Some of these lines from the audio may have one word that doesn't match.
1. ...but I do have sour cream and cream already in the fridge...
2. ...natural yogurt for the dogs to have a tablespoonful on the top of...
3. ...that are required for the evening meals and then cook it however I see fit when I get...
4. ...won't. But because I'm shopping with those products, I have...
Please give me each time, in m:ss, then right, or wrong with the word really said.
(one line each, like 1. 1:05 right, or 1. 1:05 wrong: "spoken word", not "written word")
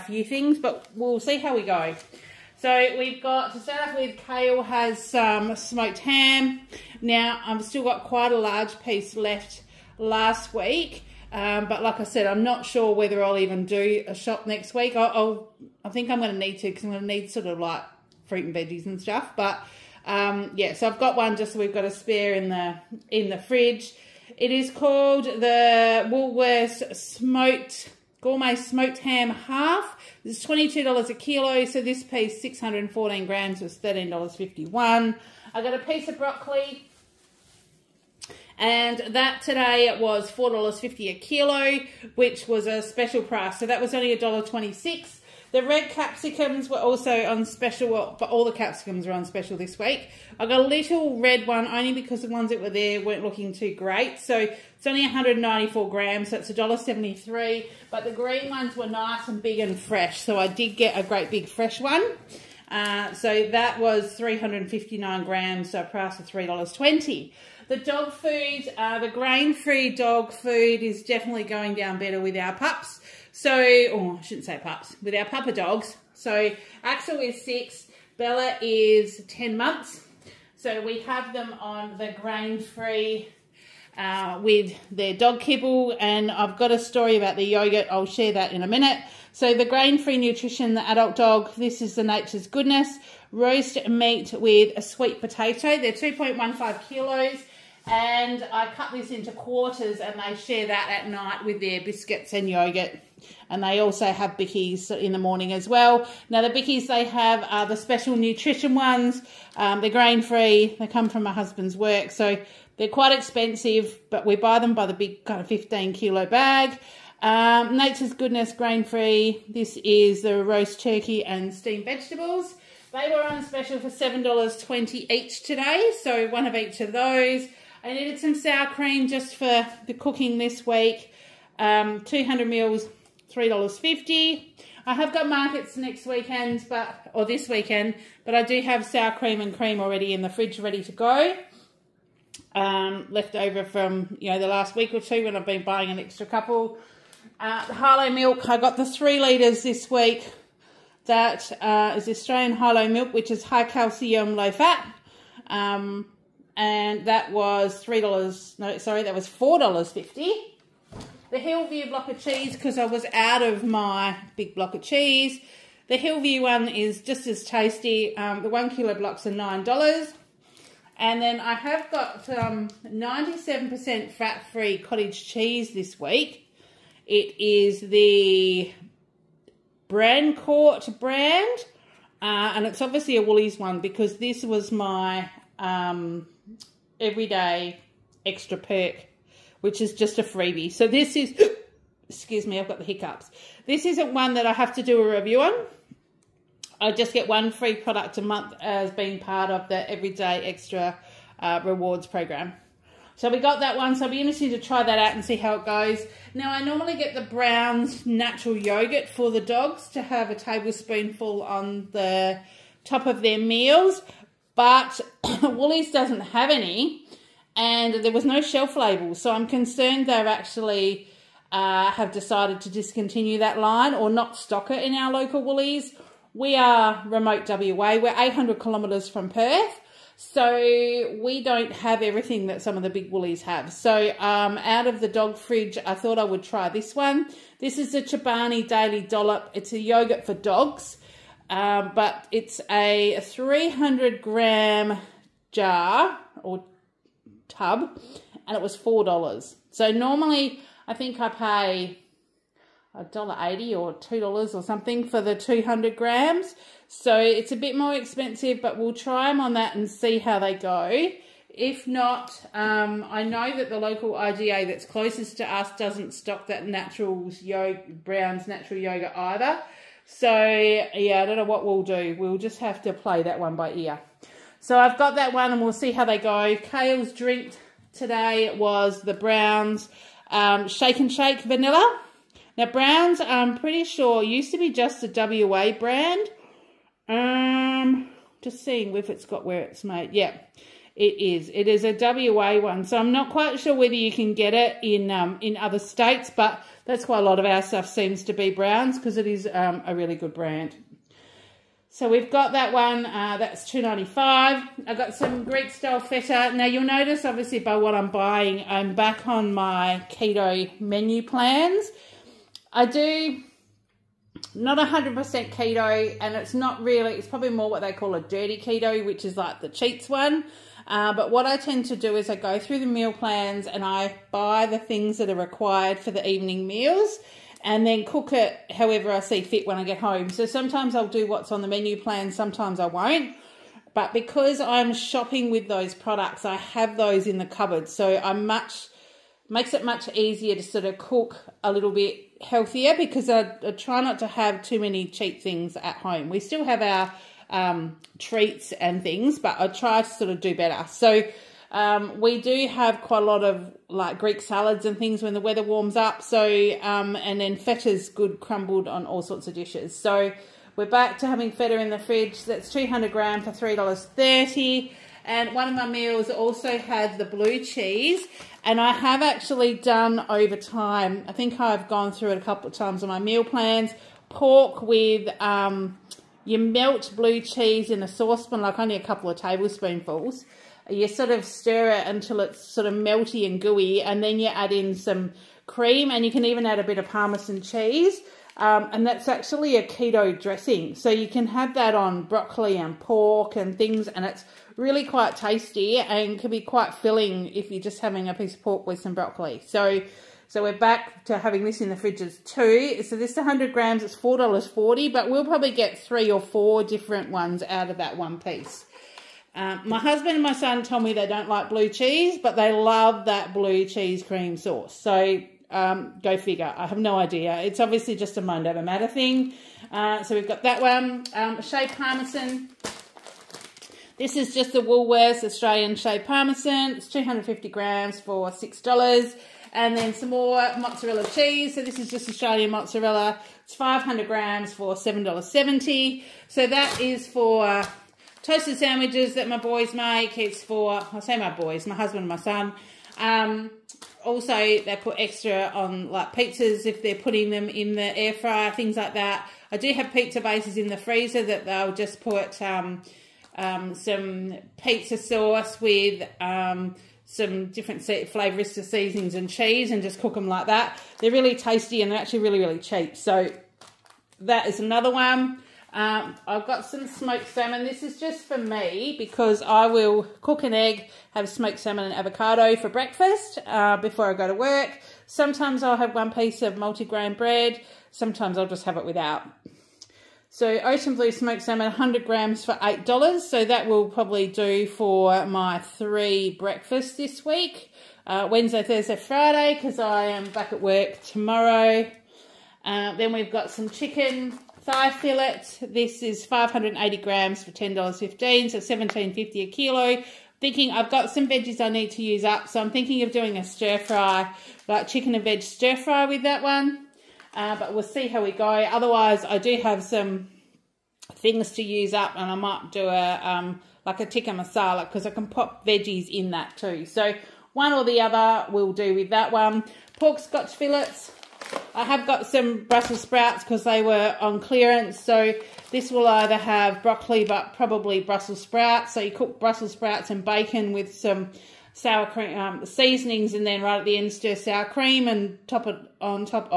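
1. 2:18 right
2. 3:28 right
3. 5:25 right
4. 5:32 right.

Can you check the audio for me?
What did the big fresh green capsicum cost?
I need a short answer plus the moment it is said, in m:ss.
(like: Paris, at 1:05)
$3.20, at 1:06.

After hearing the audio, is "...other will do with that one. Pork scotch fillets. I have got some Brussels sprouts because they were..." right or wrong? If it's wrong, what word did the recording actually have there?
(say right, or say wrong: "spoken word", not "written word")
right.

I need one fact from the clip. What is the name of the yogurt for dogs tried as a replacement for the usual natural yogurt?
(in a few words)
Chobani Daily Dollop.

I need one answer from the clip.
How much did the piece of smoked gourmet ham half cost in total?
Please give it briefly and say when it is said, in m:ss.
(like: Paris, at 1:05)
$13.51, at 0:33.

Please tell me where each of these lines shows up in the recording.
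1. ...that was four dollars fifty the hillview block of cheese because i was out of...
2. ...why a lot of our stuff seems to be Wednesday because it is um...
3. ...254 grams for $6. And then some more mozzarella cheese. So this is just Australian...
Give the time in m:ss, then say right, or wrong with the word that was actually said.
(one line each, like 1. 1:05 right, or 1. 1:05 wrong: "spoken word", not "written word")
1. 2:39 right
2. 4:57 wrong: "Brownes", not "Wednesday"
3. 7:07 wrong: "250", not "254".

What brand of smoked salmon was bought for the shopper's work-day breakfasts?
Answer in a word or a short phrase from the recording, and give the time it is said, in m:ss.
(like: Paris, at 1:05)
Ocean Blue, at 8:00.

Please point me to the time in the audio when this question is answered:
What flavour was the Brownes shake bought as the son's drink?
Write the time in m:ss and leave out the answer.
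4:41.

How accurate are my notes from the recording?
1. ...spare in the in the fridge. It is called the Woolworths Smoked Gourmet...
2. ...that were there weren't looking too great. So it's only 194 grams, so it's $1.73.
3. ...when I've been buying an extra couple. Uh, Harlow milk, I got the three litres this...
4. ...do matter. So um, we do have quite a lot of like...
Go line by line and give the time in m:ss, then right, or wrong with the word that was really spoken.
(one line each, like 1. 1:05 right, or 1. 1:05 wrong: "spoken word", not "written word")
1. 0:21 right
2. 0:52 right
3. 2:25 right
4. 5:50 wrong: "better", not "matter".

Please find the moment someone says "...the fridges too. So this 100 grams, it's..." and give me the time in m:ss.
6:41.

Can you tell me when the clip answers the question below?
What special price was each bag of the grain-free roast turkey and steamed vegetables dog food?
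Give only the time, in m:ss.
2:03.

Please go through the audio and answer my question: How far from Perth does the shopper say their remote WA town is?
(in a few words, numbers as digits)
800 kilometres.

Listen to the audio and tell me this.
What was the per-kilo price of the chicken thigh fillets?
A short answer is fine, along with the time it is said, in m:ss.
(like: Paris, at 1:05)
$17.50, at 8:18.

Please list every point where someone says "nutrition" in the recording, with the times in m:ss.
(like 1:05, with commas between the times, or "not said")
1:30, 1:48.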